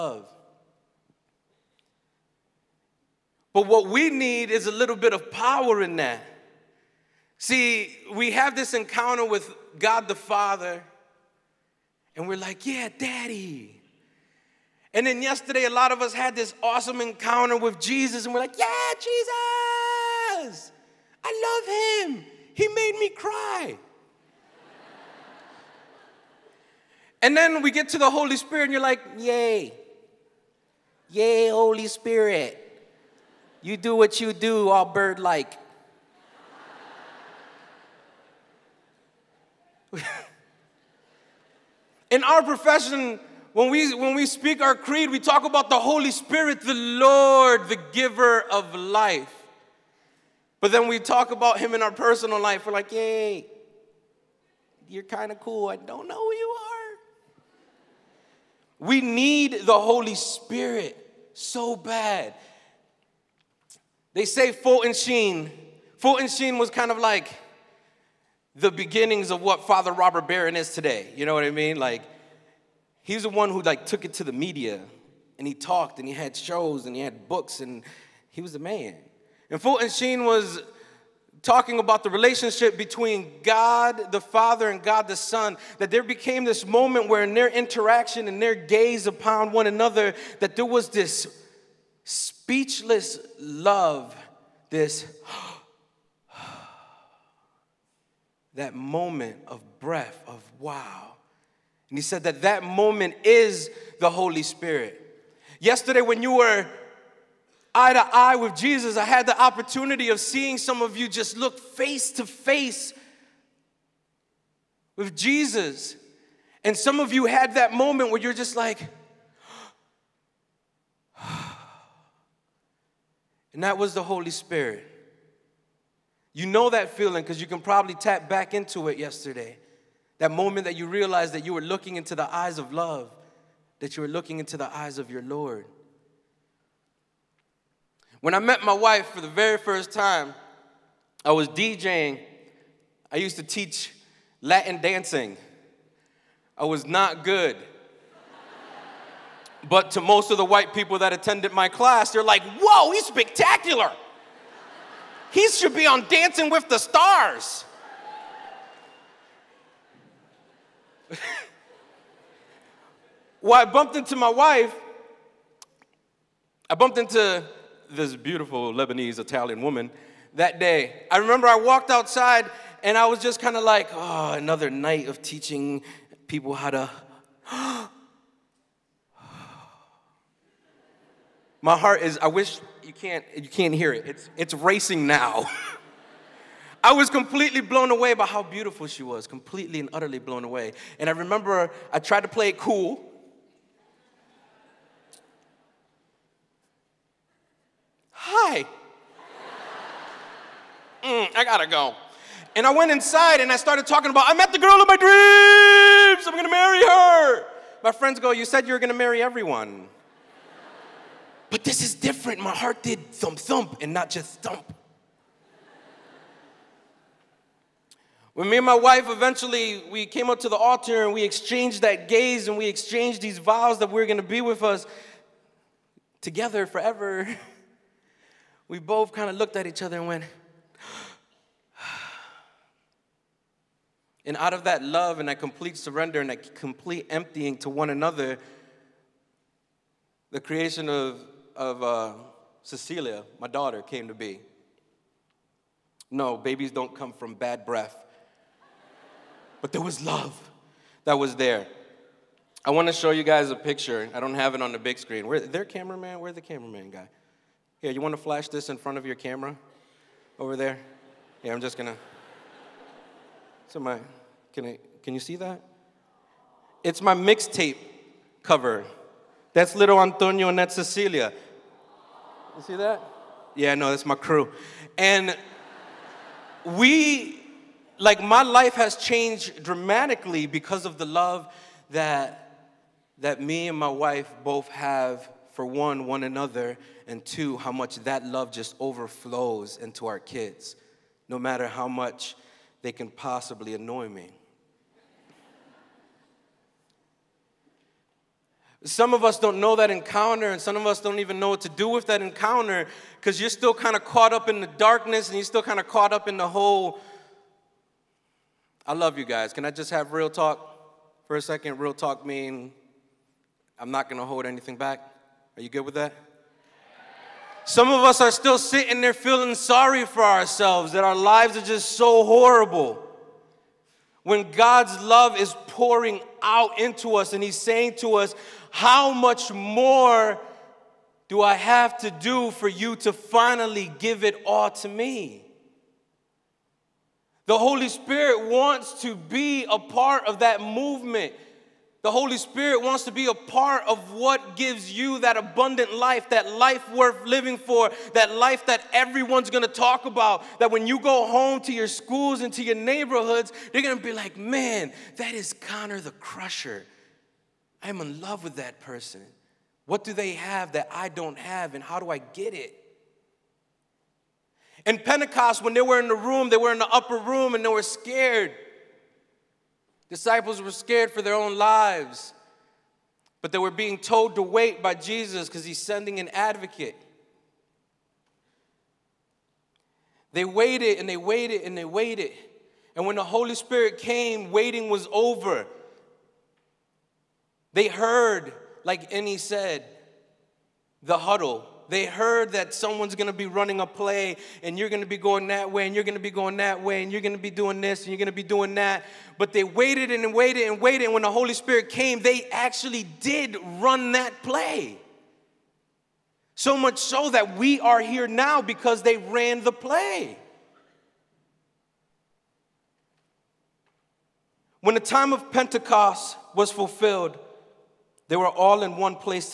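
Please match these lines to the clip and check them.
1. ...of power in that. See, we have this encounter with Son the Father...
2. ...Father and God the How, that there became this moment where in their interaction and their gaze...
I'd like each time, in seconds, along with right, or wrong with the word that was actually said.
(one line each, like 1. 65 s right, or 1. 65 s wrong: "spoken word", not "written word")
1. 5 s wrong: "God", not "Son"
2. 84 s wrong: "Son", not "How".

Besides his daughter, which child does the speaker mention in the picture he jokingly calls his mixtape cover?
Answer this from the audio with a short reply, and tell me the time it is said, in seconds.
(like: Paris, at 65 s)
Antonio, at 269 s.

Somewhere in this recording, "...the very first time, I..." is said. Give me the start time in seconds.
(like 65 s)
139 s.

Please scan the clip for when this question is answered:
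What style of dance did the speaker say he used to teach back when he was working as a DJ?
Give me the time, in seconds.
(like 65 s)
144 s.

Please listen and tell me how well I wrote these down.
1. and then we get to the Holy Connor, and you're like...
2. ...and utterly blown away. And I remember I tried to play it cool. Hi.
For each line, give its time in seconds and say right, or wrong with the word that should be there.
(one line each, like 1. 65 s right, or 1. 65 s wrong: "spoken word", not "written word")
1. 27 s wrong: "Spirit", not "Connor"
2. 189 s right.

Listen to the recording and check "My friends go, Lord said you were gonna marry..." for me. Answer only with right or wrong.
wrong.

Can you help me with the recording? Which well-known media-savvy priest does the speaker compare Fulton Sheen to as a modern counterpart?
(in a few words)
Father Robert Barron.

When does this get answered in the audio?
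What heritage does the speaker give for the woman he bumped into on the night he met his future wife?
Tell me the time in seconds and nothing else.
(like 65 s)
168 s.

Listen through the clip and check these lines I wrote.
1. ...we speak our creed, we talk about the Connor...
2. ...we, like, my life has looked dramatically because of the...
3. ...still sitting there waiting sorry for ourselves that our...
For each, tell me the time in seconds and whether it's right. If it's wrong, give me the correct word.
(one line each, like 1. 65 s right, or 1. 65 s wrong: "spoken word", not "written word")
1. 44 s wrong: "Holy", not "Connor"
2. 276 s wrong: "changed", not "looked"
3. 318 s wrong: "feeling", not "waiting".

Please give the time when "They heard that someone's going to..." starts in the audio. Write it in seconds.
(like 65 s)
391 s.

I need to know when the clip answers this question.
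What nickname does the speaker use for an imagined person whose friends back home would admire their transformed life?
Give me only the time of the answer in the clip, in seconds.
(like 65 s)
355 s.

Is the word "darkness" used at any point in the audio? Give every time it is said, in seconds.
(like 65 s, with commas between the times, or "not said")
304 s.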